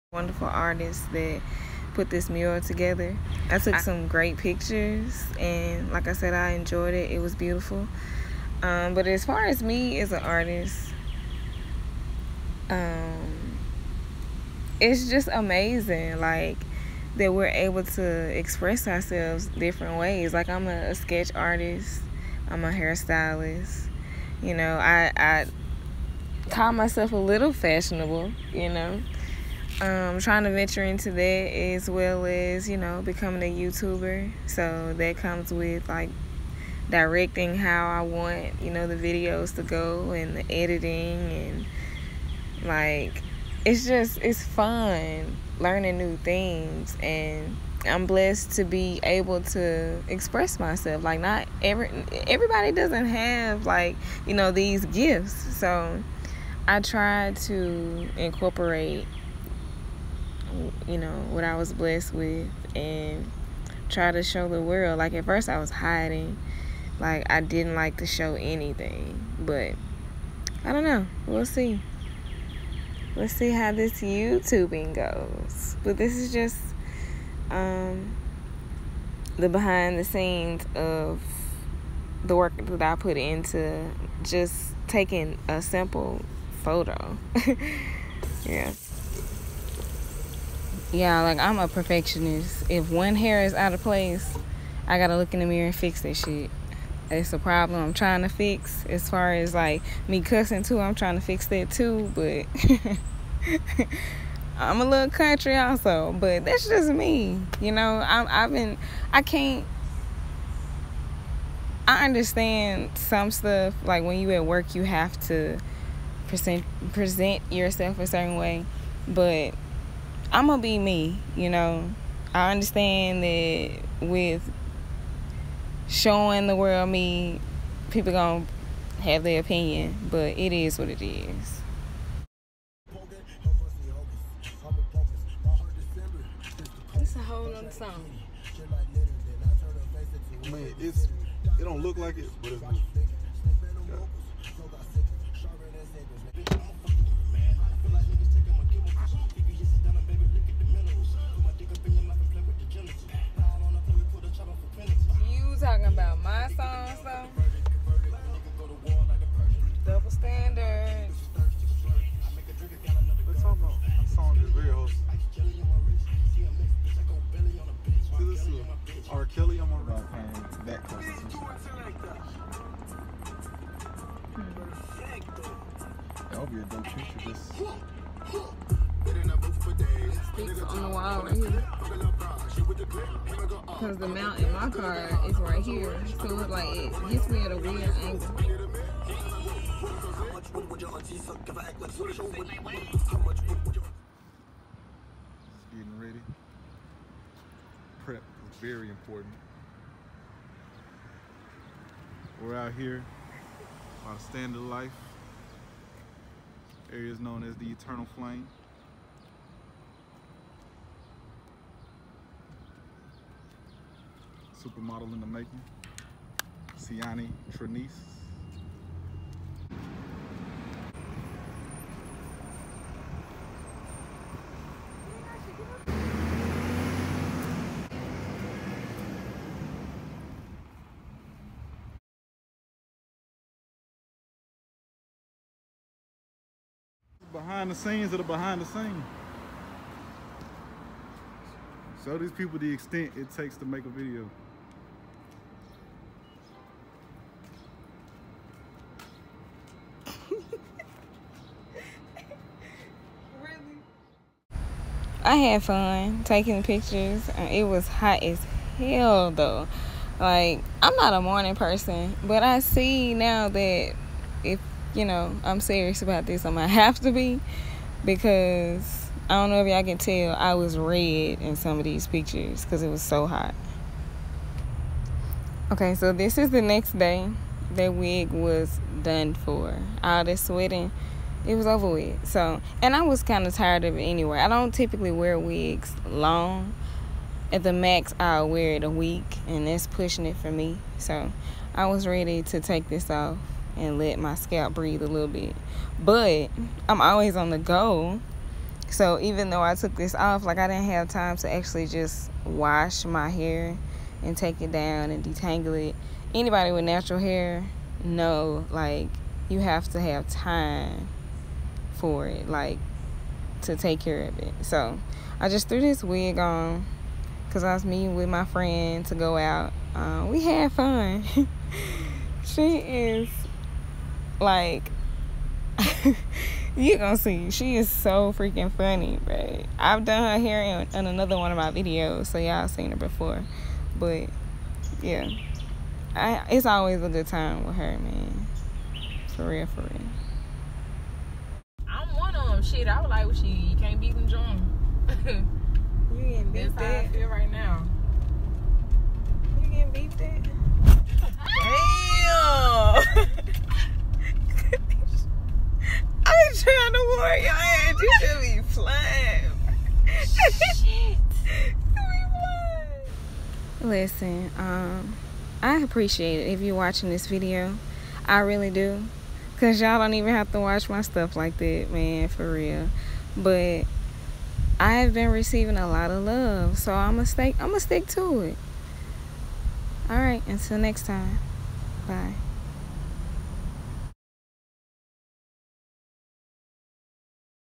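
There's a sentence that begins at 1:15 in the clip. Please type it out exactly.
But this is just um the behind the scenes of the work that I put into just taking a simple photo.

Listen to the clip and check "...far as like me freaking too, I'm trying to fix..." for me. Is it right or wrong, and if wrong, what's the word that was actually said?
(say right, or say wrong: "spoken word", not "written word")
wrong: "cussing", not "freaking".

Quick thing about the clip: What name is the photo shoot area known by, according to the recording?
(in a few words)
Eternal Flame.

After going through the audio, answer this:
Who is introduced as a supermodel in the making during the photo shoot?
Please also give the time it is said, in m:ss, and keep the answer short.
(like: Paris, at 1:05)
Ciani Trenice, at 3:36.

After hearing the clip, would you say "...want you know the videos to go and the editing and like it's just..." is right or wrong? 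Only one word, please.
right.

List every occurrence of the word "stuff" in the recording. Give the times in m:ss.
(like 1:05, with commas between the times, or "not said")
1:53, 6:11.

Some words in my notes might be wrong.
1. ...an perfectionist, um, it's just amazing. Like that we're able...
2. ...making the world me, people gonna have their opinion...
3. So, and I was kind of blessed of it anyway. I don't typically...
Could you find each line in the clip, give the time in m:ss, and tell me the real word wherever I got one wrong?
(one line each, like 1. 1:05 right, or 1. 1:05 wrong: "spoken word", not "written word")
1. 0:10 wrong: "artist", not "perfectionist"
2. 2:05 wrong: "showing", not "making"
3. 4:42 wrong: "tired", not "blessed".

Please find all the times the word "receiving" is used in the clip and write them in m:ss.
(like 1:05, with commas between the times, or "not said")
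6:15.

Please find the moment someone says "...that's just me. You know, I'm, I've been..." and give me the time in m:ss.
1:46.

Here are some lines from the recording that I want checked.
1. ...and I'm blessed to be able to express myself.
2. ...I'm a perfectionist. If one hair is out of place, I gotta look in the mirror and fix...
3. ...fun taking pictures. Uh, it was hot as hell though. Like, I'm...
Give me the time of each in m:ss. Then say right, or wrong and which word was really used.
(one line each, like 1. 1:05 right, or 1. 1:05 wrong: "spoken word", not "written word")
1. 0:47 right
2. 1:31 right
3. 4:15 right.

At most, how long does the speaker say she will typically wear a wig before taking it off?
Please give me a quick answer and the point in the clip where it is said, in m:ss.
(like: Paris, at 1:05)
A week, at 4:48.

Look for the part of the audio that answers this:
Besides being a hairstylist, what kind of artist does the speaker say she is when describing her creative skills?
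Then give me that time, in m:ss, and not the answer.
0:20.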